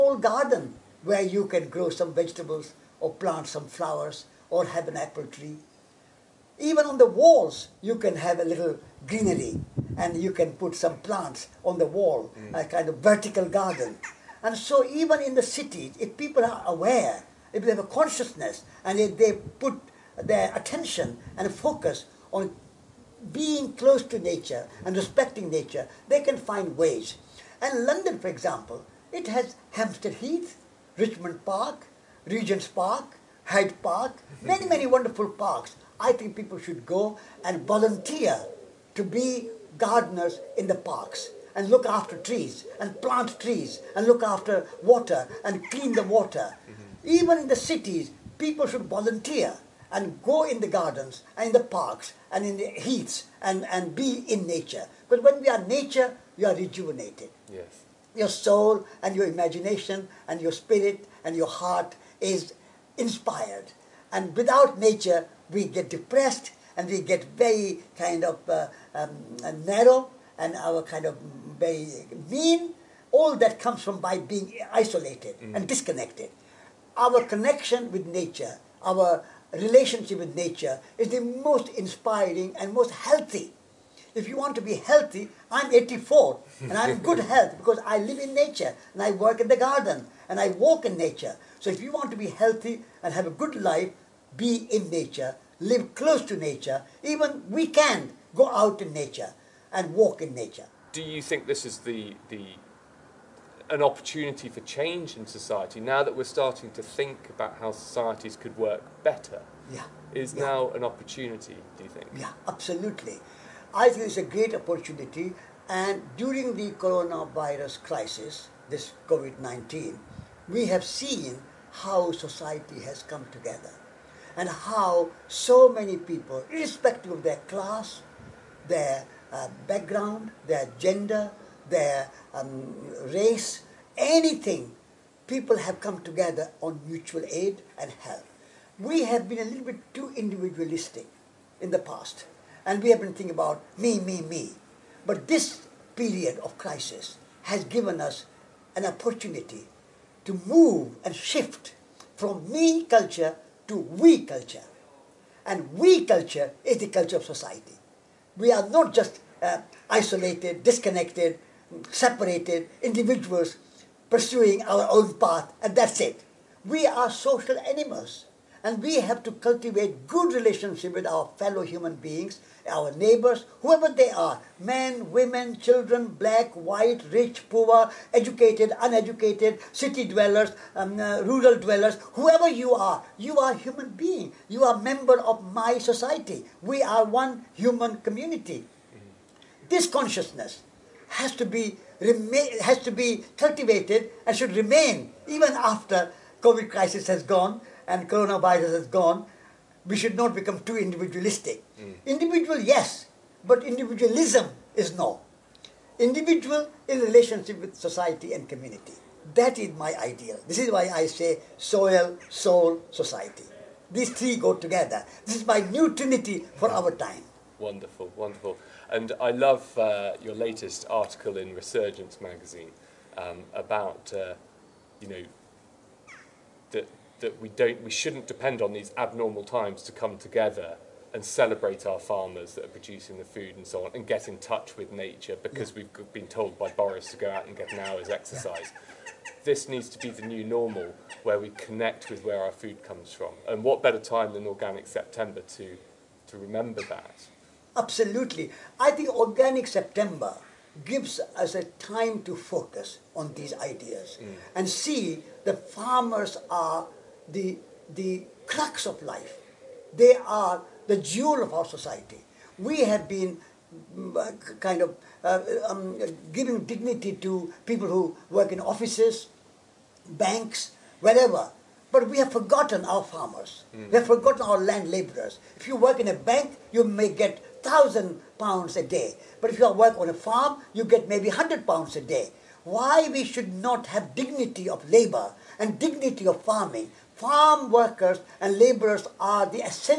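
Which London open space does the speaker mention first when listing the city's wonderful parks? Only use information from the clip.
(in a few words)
Hampstead Heath.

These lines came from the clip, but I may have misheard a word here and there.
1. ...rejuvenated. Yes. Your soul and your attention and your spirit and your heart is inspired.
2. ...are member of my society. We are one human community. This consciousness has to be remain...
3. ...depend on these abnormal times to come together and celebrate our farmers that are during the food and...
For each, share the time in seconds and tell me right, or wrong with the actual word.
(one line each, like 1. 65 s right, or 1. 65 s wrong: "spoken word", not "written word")
1. 56 s wrong: "imagination", not "attention"
2. 184 s right
3. 228 s wrong: "producing", not "during".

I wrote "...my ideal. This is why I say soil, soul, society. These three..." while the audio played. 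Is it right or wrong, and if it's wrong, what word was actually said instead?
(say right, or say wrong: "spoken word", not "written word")
right.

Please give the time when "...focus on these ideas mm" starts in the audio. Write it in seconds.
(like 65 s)
252 s.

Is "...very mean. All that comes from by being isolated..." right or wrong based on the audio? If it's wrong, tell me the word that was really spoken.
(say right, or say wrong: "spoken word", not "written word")
right.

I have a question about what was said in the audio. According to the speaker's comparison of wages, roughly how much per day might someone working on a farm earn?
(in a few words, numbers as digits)
£100.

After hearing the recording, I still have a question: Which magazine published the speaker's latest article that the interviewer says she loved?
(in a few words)
Resurgence.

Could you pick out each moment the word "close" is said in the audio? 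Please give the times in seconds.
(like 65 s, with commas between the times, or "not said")
23 s, 95 s.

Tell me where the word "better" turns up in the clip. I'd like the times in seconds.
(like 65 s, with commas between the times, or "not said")
109 s, 243 s.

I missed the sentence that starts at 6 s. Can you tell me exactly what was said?
Even on the walls, you can have a little greenery and you can put some plants on the wall, mm.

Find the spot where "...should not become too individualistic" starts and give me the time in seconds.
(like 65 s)
199 s.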